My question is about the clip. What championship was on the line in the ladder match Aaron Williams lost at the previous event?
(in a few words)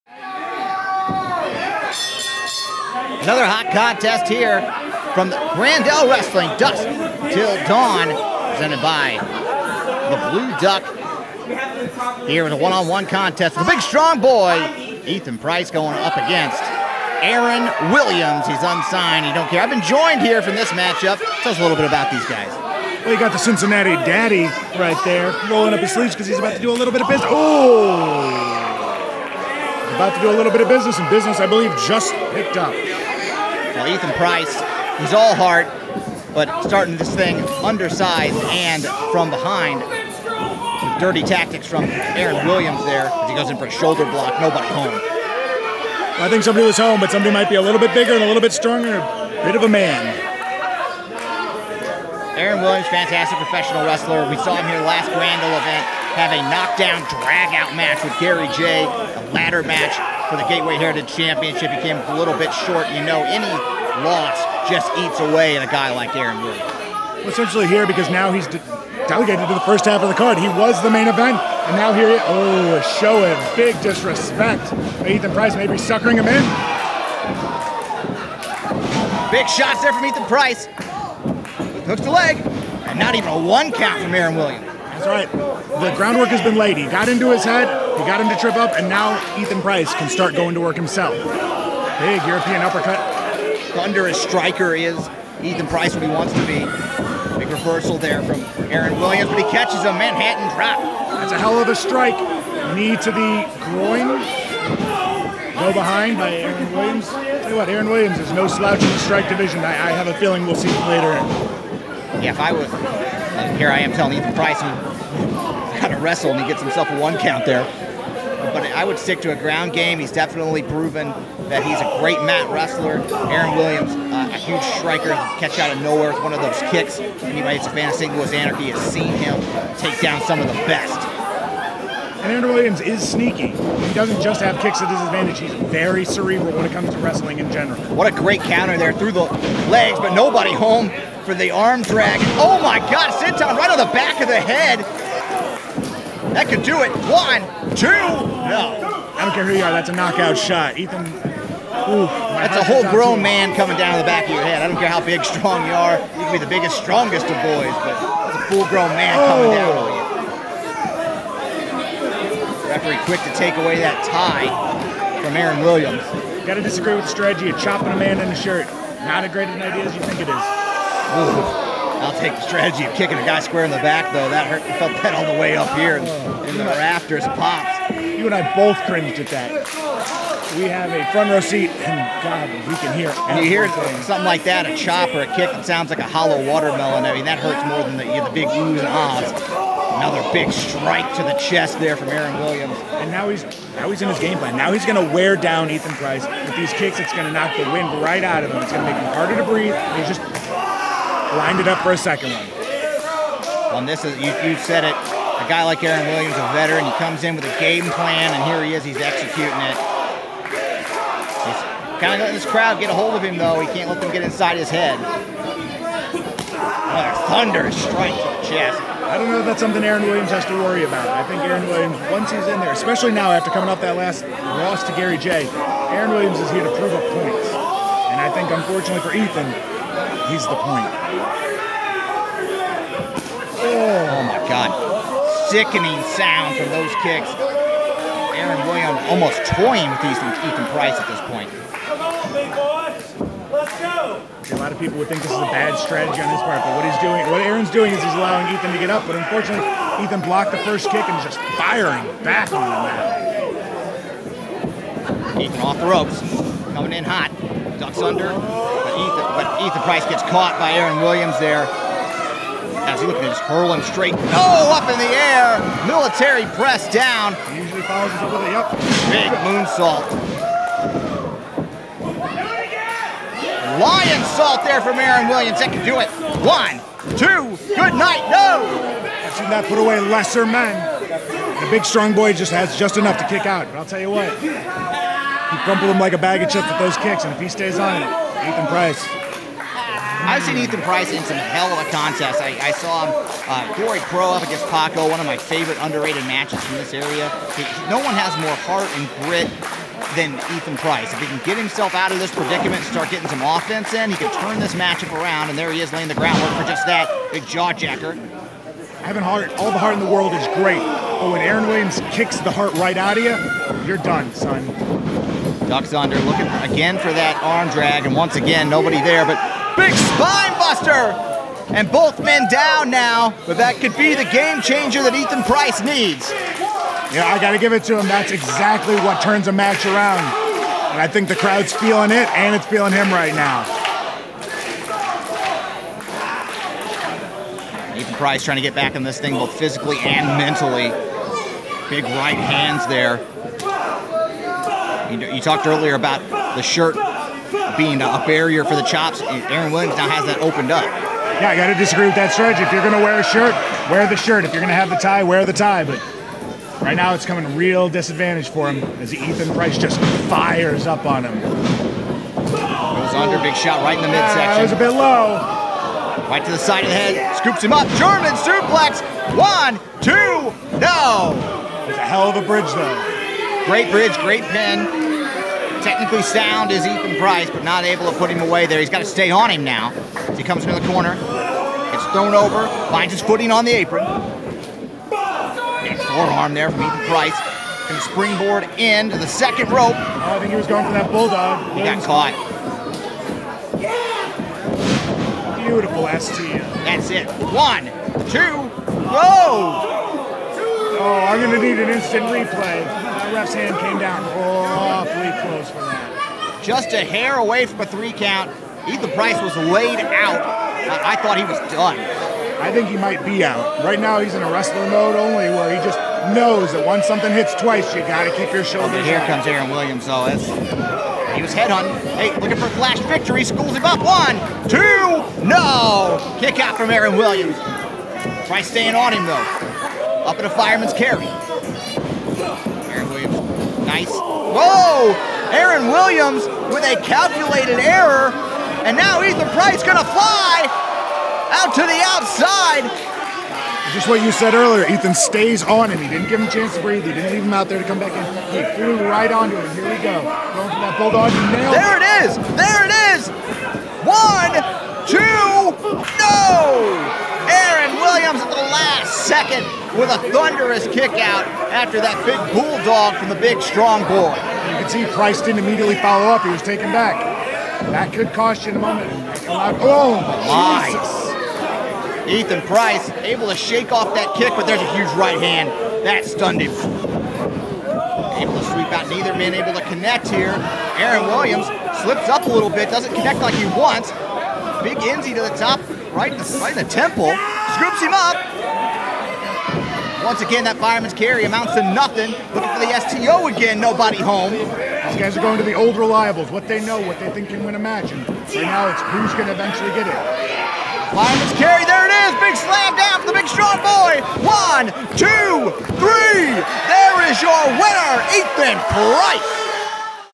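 Gateway Heritage Championship.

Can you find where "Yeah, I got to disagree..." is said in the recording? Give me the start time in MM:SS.
05:50.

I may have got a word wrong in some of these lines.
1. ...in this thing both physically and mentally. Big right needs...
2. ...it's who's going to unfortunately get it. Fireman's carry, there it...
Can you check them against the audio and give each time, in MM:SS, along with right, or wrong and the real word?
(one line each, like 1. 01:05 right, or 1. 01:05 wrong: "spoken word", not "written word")
1. 05:38 wrong: "hands", not "needs"
2. 08:18 wrong: "eventually", not "unfortunately".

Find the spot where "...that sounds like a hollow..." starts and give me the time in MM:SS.
03:05.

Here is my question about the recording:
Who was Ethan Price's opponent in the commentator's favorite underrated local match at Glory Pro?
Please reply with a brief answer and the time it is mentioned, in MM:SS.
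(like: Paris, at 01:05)
Paco, at 04:54.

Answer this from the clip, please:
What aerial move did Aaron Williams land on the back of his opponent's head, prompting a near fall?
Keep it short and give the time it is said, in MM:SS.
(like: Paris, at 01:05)
Senton, at 02:23.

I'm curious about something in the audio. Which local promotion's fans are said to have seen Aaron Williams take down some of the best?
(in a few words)
St Louis Anarchy.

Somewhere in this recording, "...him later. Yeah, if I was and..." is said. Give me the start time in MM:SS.
01:50.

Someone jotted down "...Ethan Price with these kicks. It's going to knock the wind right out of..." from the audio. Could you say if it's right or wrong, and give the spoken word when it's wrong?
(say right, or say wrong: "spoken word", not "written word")
right.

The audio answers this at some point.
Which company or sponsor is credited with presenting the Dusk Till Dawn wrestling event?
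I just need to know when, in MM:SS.
00:10.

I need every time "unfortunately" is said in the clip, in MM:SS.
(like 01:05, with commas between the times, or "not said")
03:48, 04:09.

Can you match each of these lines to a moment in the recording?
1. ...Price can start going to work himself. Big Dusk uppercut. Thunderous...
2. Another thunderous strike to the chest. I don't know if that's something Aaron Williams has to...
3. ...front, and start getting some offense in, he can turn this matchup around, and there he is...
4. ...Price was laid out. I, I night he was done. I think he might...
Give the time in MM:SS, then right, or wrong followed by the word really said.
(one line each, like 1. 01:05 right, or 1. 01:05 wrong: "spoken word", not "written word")
1. 01:29 wrong: "European", not "Dusk"
2. 03:34 right
3. 05:02 wrong: "predicament", not "front"
4. 06:49 wrong: "thought", not "night".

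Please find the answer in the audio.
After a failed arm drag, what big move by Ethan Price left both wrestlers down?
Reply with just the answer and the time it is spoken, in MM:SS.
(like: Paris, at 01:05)
spine buster, at 05:19.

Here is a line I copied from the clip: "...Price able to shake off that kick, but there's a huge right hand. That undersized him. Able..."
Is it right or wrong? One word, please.
wrong.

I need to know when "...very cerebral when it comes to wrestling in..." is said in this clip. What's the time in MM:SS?
02:15.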